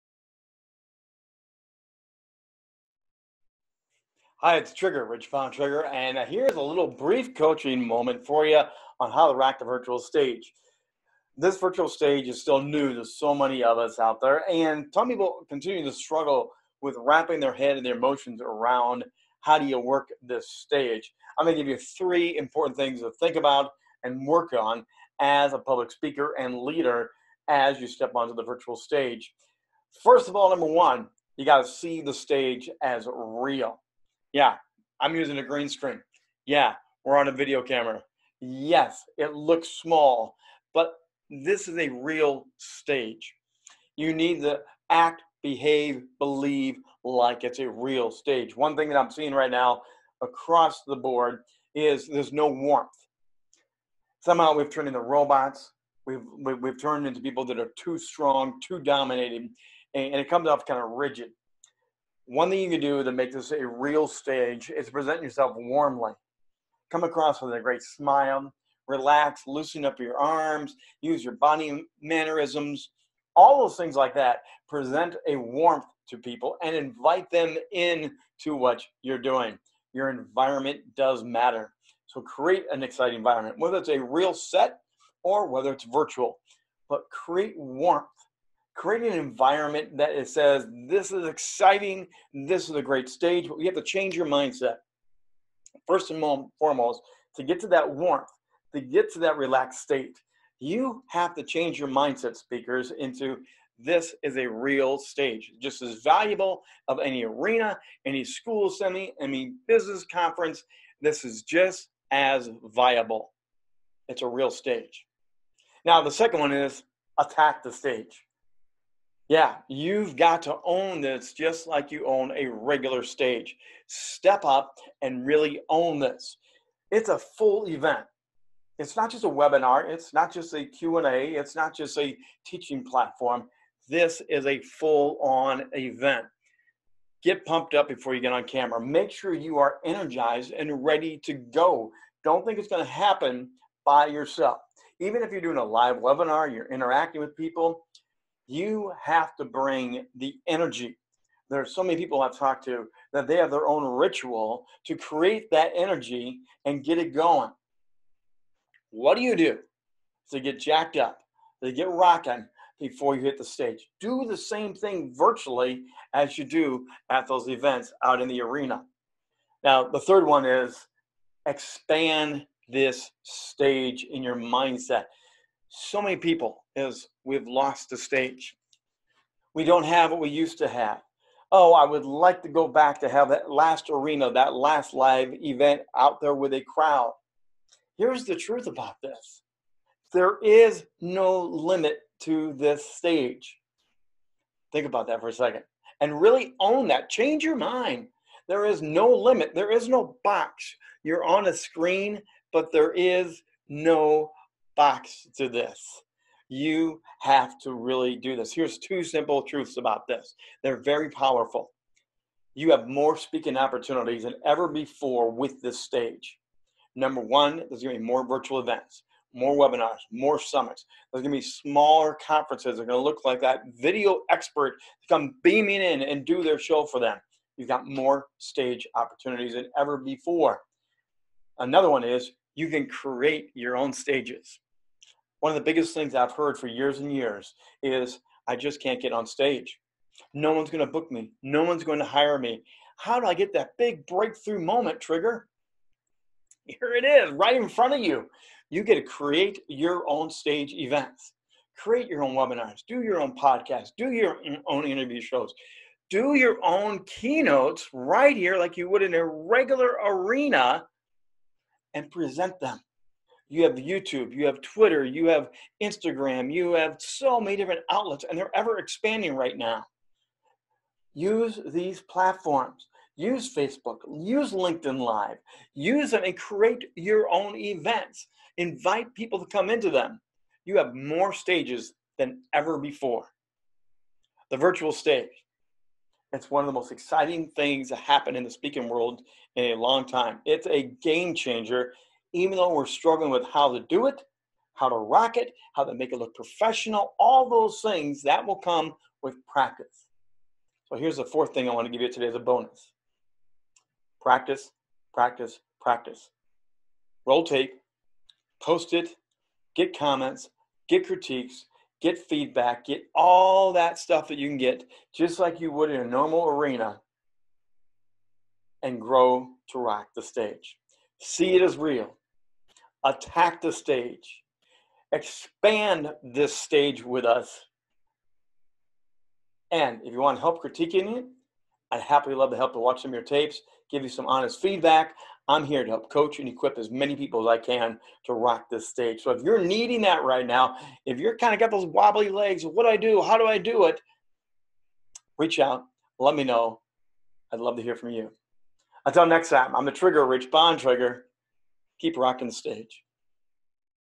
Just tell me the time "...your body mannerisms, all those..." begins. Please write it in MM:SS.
01:11.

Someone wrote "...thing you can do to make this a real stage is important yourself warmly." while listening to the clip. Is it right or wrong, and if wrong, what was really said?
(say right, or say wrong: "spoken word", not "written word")
wrong: "present", not "important".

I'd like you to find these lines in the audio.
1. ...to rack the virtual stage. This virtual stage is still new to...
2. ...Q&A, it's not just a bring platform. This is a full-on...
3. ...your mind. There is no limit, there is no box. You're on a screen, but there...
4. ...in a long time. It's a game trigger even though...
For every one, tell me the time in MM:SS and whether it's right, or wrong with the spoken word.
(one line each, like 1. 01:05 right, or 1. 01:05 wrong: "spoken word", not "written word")
1. 00:09 right
2. 02:10 wrong: "teaching", not "bring"
3. 03:17 right
4. 04:49 wrong: "changer", not "trigger".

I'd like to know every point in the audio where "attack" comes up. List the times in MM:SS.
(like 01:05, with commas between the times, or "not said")
01:57, 05:23.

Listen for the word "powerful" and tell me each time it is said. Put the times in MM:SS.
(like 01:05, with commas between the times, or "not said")
03:31.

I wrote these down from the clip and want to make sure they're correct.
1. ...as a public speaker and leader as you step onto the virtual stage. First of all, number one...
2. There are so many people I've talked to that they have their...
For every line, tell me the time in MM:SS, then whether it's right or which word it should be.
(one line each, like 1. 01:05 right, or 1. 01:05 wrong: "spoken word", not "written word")
1. 00:25 right
2. 02:31 right.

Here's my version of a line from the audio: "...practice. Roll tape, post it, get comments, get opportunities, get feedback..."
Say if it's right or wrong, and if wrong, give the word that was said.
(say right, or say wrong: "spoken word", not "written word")
wrong: "critiques", not "opportunities".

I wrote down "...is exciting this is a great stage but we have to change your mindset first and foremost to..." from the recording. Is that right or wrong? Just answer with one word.
right.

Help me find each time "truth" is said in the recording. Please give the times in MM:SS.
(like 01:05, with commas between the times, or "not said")
03:08, 03:29.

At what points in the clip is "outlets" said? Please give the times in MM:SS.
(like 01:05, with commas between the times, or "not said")
04:27.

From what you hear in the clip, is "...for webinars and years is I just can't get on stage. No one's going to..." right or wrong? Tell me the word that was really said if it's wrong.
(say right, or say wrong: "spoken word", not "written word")
wrong: "years", not "webinars".